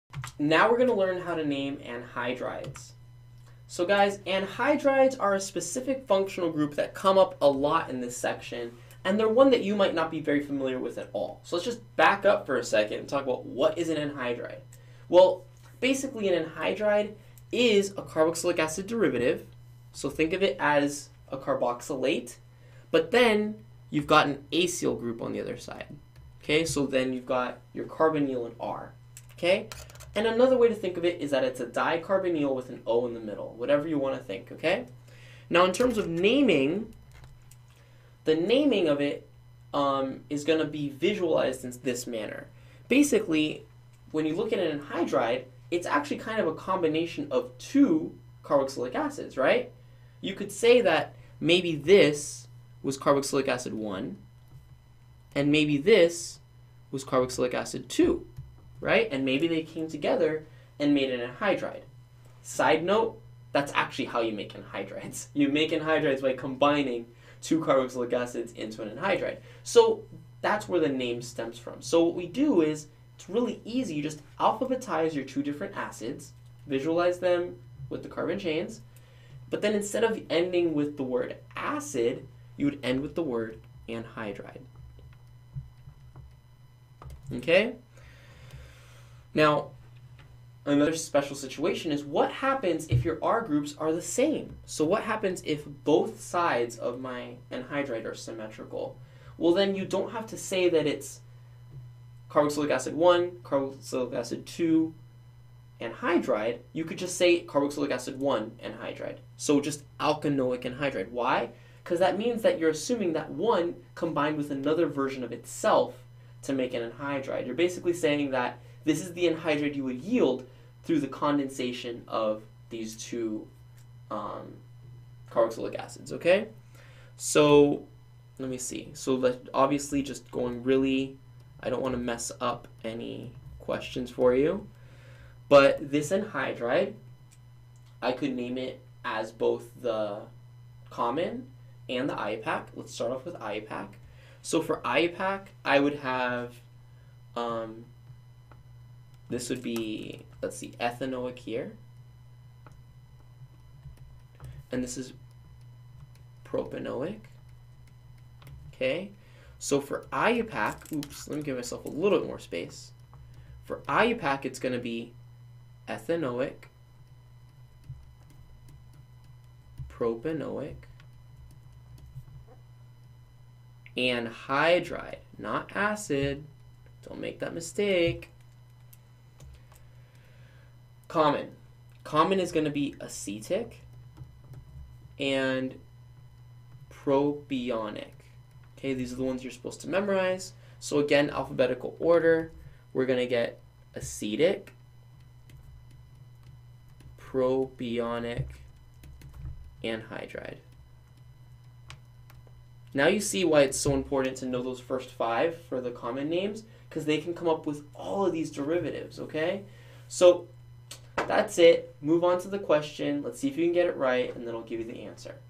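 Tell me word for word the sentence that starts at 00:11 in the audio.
So let's just back up for a second and talk about what is an anhydride.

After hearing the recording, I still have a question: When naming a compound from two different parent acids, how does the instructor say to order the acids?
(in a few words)
Alphabetize.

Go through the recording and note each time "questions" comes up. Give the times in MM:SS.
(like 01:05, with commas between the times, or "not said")
02:13, 03:32.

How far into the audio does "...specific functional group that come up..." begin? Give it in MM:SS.
00:05.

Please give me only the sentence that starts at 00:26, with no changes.
Okay, so then you've got your carbonyl and R.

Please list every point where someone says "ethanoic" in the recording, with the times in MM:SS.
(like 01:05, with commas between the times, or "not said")
02:30, 02:45.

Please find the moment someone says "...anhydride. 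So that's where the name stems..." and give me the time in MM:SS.
01:08.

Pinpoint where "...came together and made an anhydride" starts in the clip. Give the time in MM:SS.
00:59.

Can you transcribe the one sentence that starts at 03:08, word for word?
Okay, these are the ones you're supposed to memorize.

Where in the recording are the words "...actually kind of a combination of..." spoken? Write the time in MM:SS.
00:45.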